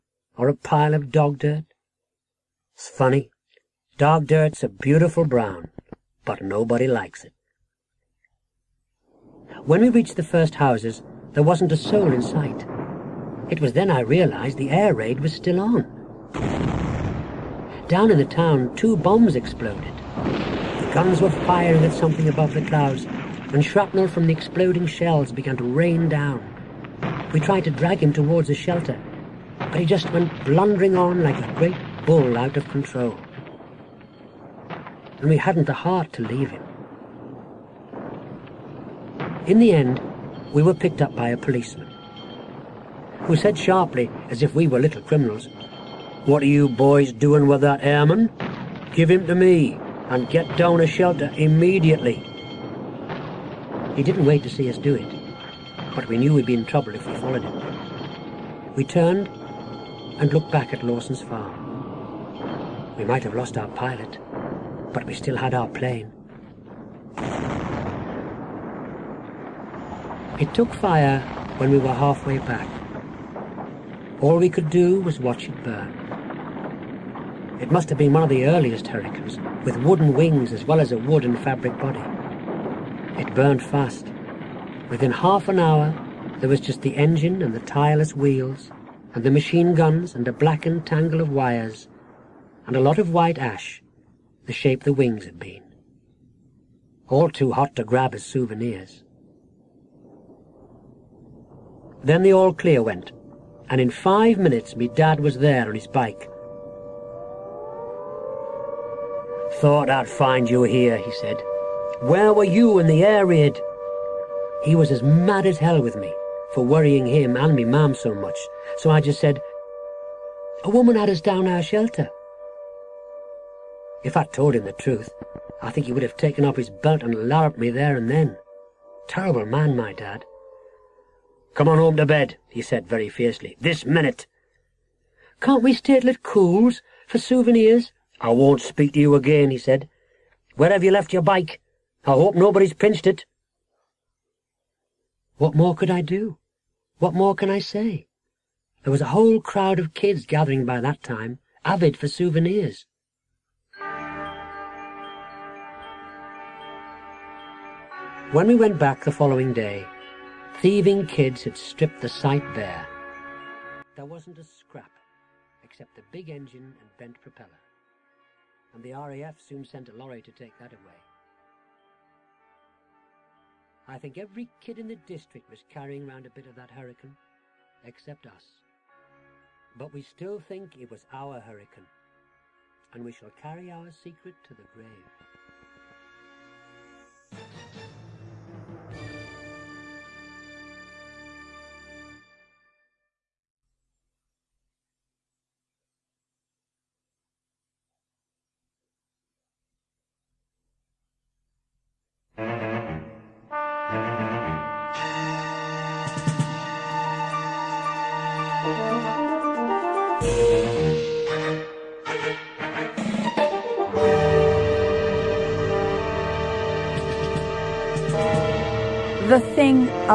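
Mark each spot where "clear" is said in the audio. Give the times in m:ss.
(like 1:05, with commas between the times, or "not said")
1:42.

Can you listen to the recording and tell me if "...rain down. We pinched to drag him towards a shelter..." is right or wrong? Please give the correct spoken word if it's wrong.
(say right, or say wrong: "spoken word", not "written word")
wrong: "tried", not "pinched".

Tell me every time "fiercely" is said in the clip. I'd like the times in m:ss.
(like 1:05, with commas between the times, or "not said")
2:13.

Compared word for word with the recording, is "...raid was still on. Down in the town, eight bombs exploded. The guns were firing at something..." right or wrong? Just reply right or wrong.
wrong.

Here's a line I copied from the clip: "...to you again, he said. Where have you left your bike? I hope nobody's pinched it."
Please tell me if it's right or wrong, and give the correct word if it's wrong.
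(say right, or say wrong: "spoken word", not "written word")
right.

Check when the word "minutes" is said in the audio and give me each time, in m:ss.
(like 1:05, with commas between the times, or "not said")
1:44, 2:13.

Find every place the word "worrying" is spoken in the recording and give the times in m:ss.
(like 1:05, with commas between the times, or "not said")
1:56.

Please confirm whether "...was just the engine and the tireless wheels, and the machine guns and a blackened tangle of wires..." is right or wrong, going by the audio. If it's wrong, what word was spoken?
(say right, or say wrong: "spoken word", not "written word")
right.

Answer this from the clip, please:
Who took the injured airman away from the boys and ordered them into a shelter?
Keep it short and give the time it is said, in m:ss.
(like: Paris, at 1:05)
A policeman, at 0:41.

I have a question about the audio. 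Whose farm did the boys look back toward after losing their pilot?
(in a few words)
Lawson's farm.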